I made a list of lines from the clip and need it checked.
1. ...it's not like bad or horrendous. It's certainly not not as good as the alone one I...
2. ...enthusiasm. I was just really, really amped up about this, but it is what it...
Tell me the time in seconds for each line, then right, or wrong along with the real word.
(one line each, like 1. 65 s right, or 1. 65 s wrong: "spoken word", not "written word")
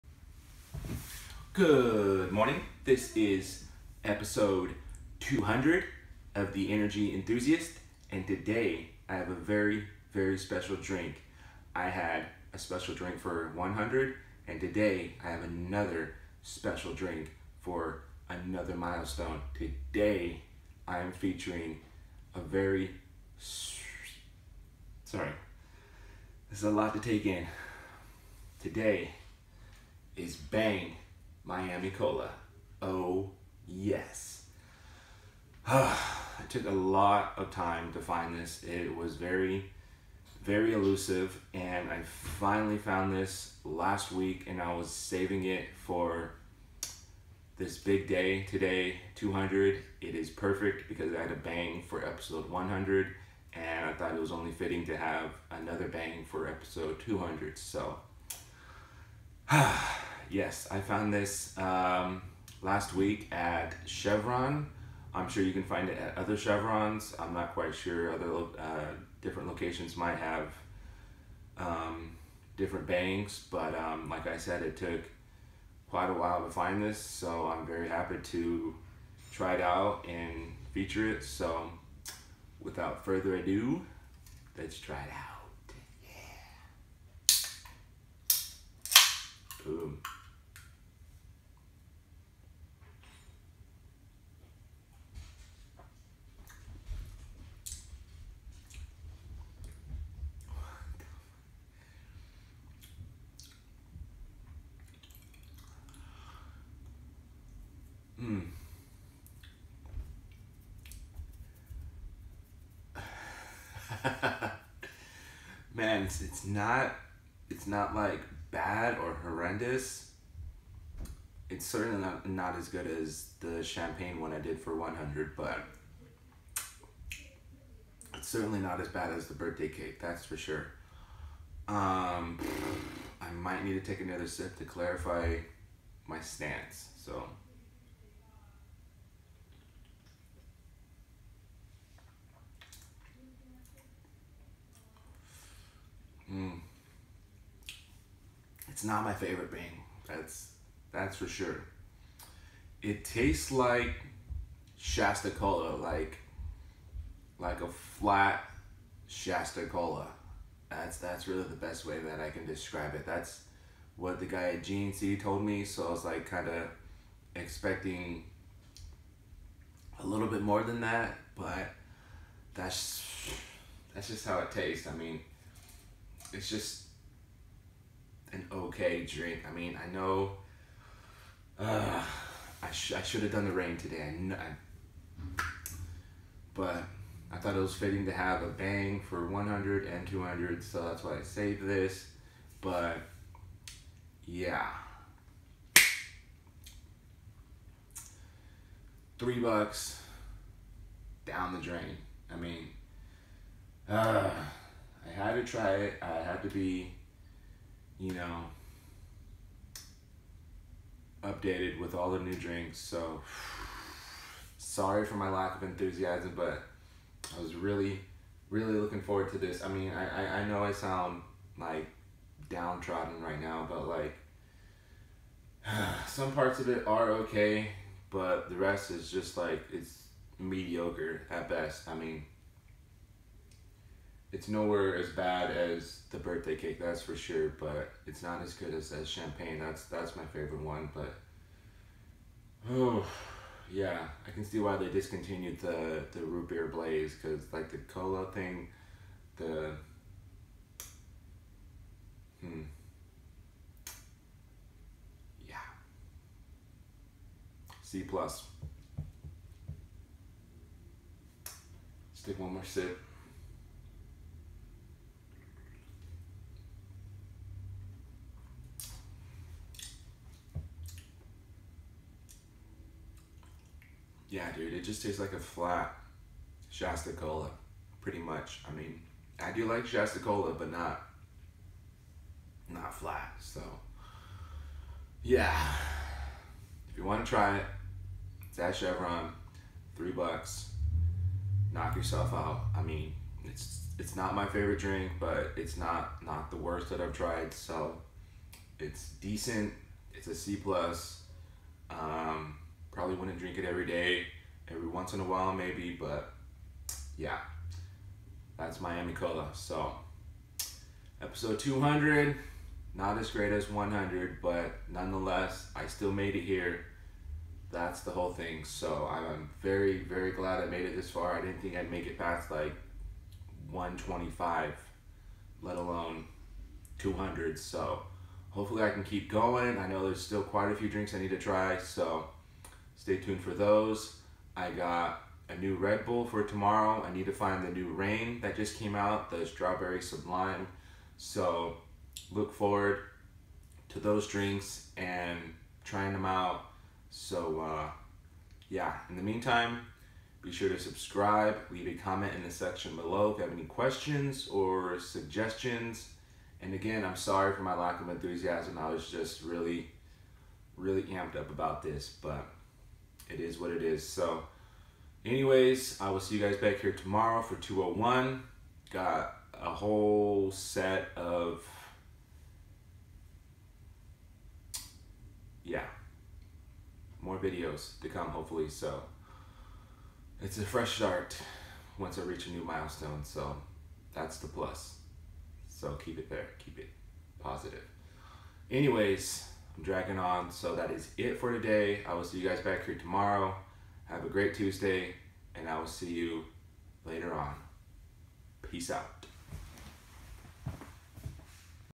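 1. 117 s wrong: "champagne", not "alone"
2. 358 s right.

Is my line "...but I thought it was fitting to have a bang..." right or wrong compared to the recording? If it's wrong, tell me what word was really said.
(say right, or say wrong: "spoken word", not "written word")
right.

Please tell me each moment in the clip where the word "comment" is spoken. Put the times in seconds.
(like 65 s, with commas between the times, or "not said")
351 s.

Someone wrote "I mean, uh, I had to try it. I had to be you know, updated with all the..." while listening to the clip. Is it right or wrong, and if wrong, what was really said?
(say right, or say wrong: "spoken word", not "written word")
right.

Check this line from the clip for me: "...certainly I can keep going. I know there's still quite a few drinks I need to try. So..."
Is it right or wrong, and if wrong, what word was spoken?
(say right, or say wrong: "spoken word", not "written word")
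wrong: "hopefully", not "certainly".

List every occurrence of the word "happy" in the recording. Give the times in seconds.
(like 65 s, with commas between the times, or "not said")
77 s.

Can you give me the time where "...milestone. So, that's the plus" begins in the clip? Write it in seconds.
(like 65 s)
382 s.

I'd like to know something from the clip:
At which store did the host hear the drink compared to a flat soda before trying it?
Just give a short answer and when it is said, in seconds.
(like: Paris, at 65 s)
GNC, at 164 s.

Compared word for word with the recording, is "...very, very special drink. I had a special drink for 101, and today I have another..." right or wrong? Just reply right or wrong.
wrong.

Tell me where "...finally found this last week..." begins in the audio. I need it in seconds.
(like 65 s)
42 s.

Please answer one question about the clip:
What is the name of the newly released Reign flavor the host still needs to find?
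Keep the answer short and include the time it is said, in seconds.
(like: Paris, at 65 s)
Strawberry Sublime, at 339 s.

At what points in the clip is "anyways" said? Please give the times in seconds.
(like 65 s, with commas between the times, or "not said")
365 s, 388 s.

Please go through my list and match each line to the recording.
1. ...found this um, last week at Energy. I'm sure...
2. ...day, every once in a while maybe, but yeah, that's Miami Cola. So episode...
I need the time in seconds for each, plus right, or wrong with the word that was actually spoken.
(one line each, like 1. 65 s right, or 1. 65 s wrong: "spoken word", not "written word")
1. 60 s wrong: "Chevron", not "Energy"
2. 303 s right.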